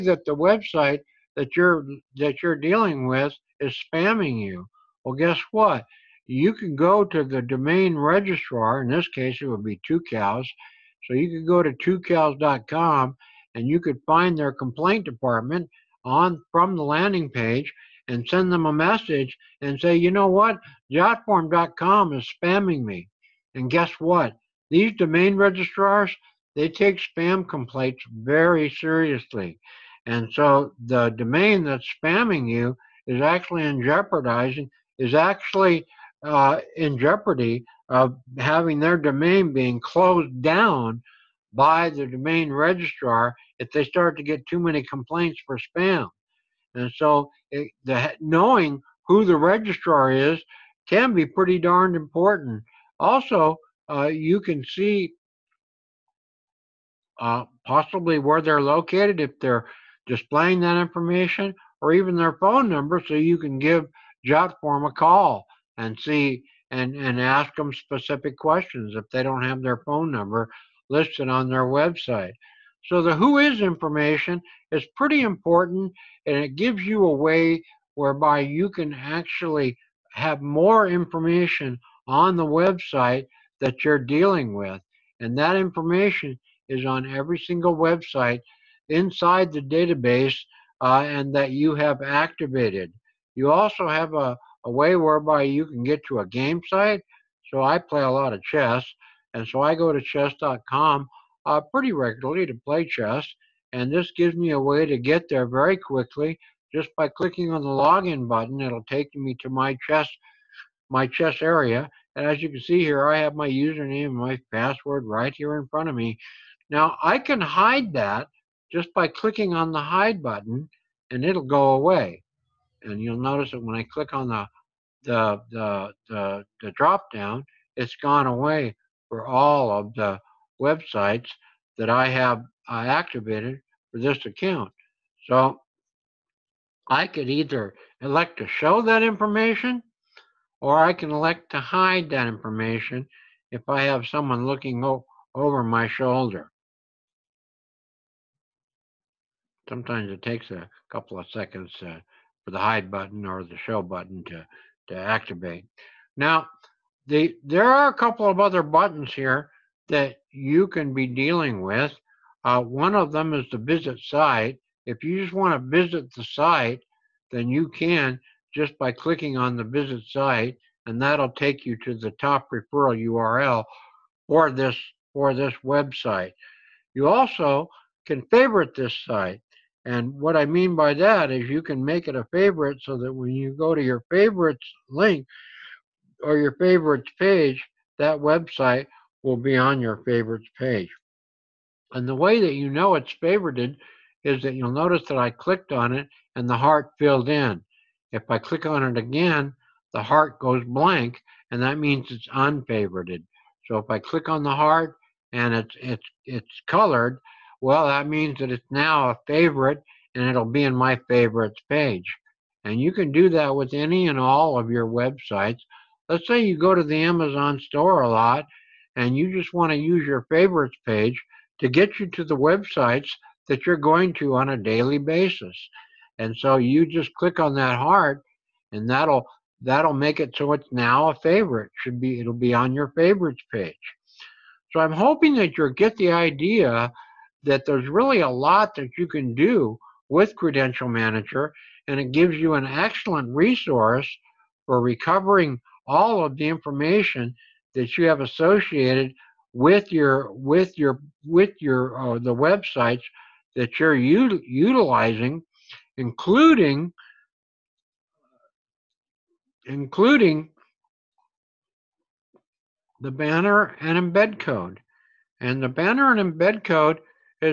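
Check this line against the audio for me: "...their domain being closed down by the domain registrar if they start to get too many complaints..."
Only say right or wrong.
right.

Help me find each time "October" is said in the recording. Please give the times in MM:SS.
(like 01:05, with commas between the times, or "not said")
not said.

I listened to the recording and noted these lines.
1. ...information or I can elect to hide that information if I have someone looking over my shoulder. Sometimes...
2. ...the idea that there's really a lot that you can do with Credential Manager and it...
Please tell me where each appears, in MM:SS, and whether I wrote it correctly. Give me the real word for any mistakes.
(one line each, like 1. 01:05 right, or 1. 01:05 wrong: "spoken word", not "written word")
1. 02:19 right
2. 03:55 right.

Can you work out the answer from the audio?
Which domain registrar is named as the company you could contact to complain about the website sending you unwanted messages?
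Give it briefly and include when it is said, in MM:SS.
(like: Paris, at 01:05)
Tucows, at 00:09.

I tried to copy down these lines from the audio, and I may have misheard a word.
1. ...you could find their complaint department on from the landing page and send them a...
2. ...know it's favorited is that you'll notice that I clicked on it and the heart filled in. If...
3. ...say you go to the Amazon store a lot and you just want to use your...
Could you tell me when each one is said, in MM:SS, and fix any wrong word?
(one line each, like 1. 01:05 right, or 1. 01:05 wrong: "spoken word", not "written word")
1. 00:13 right
2. 03:12 right
3. 03:36 right.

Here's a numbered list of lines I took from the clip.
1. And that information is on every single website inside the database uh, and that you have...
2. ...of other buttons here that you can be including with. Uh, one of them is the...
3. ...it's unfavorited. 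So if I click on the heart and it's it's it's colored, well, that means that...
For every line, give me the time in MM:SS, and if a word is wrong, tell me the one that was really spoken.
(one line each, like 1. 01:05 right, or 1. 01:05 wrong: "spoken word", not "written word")
1. 01:25 right
2. 02:38 wrong: "dealing", not "including"
3. 03:22 right.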